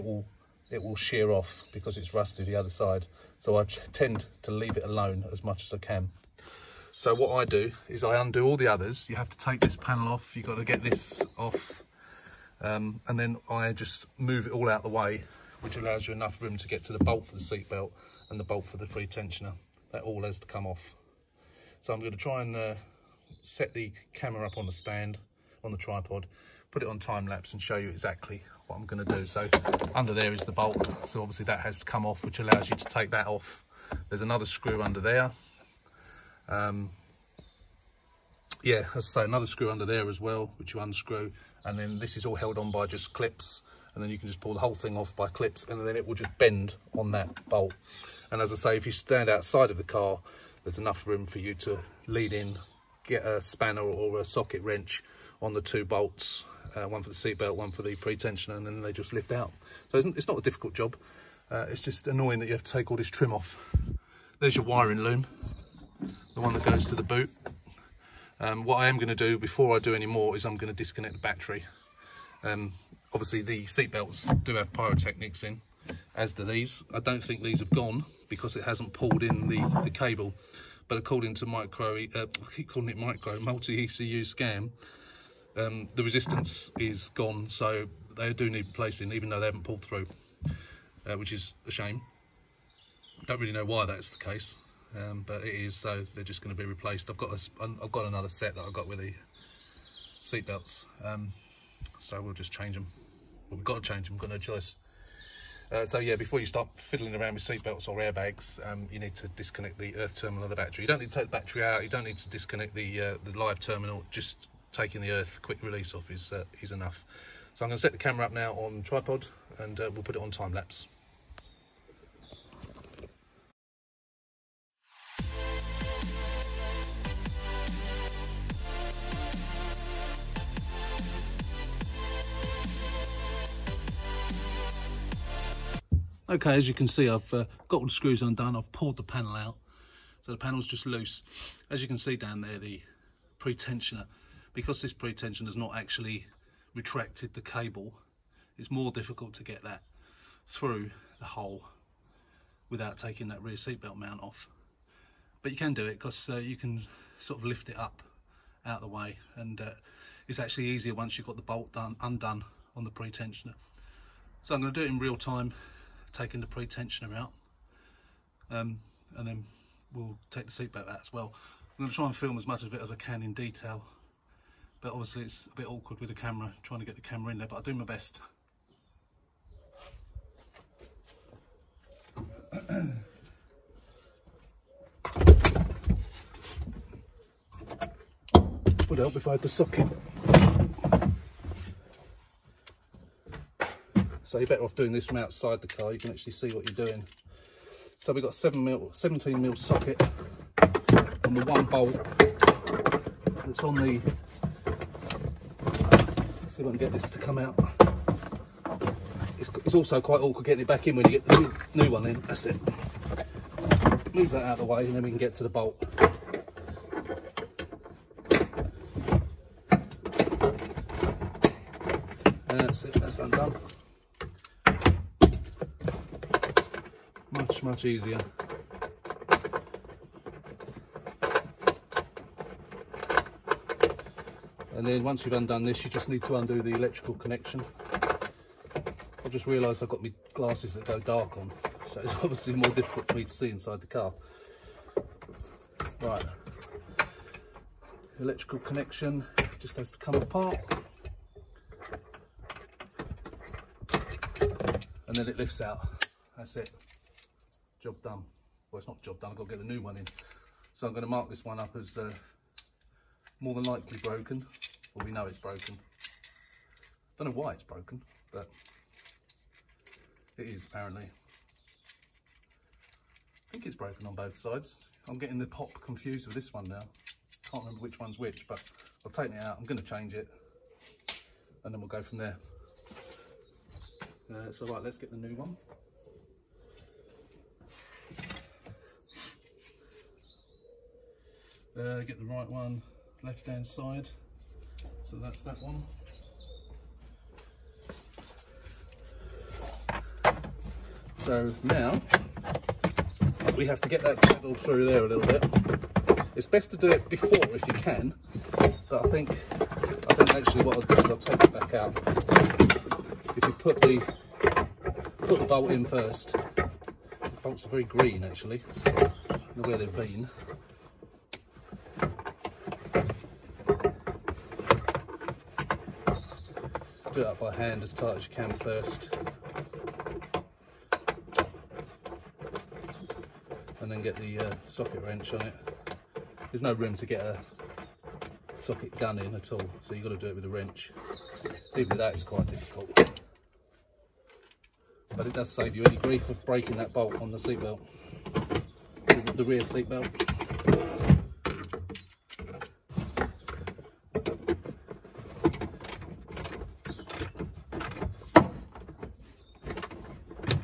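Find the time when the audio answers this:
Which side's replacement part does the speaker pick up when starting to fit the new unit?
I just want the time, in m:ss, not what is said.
4:53.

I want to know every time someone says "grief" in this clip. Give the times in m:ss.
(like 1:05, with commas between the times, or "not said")
5:45.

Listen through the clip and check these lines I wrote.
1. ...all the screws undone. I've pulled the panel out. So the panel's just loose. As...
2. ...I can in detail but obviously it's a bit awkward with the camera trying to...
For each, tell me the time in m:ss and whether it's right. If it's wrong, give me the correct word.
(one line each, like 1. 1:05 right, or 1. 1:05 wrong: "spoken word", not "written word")
1. 2:17 right
2. 2:52 right.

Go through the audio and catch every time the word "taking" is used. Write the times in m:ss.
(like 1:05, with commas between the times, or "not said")
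1:54, 2:32, 2:46.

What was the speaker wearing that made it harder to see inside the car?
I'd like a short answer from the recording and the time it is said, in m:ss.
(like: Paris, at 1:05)
glasses that go dark, at 4:00.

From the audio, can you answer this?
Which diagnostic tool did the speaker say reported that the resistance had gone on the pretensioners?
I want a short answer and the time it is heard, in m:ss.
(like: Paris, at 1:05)
Multi-ECU Scan, at 1:23.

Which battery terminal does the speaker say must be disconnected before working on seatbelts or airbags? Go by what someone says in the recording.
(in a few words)
earth terminal.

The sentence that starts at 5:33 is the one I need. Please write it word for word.
And then get the uh, socket wrench on it.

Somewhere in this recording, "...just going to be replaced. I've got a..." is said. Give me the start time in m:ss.
1:36.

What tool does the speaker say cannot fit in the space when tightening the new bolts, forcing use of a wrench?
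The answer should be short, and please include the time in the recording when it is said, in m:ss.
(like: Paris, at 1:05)
socket gun, at 5:38.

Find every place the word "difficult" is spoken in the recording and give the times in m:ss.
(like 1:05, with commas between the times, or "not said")
1:00, 2:28, 4:02, 5:42.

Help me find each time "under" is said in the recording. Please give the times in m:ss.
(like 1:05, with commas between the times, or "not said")
0:29, 0:34, 0:39.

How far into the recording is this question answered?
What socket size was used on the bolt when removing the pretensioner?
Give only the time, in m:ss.
3:18.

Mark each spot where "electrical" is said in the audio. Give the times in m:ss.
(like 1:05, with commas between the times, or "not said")
3:56, 4:08.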